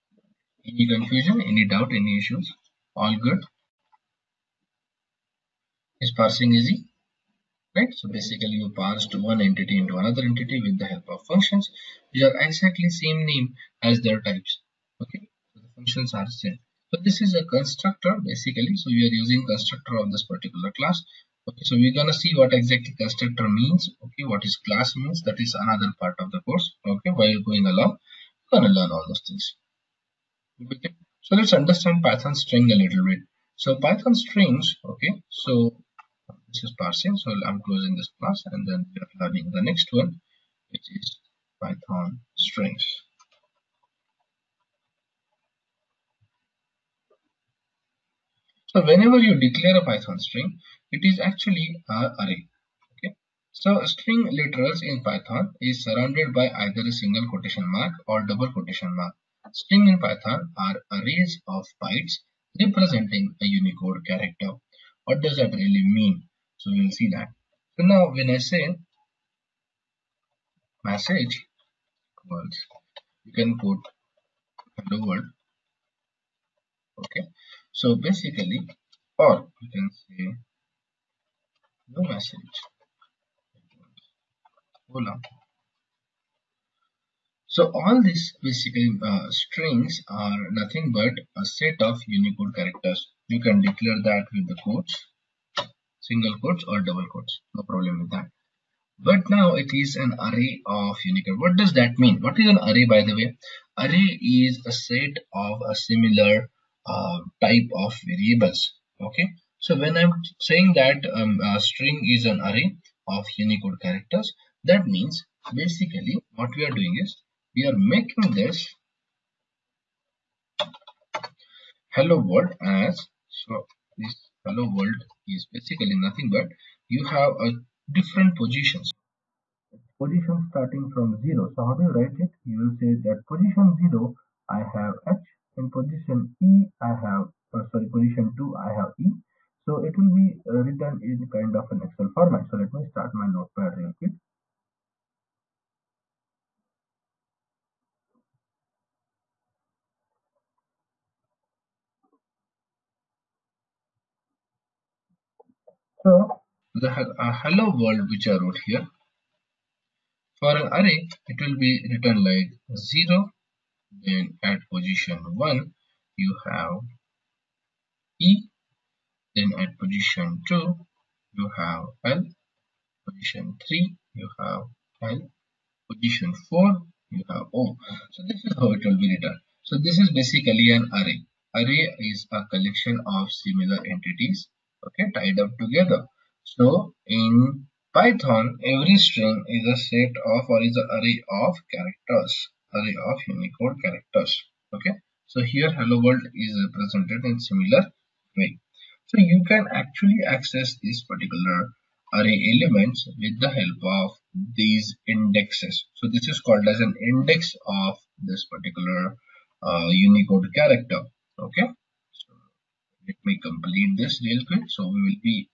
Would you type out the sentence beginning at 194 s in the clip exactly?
Okay, so here hello world is represented in similar way.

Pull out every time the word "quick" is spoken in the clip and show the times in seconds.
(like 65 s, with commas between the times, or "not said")
143 s, 214 s.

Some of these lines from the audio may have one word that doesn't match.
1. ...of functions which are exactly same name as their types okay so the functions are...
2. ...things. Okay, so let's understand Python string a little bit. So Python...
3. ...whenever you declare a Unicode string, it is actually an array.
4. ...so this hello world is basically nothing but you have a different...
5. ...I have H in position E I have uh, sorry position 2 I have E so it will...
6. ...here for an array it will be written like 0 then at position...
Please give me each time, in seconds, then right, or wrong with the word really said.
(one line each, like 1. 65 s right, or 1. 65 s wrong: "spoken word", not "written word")
1. 11 s right
2. 29 s right
3. 48 s wrong: "Python", not "Unicode"
4. 123 s right
5. 134 s right
6. 158 s right.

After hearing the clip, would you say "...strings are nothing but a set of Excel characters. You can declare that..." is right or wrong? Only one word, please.
wrong.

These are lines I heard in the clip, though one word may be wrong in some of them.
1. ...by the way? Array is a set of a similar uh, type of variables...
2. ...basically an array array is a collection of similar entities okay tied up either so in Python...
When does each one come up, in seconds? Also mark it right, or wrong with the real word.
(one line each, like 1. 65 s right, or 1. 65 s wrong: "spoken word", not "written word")
1. 102 s right
2. 180 s wrong: "together", not "either".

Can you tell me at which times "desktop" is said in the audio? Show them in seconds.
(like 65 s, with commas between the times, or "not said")
not said.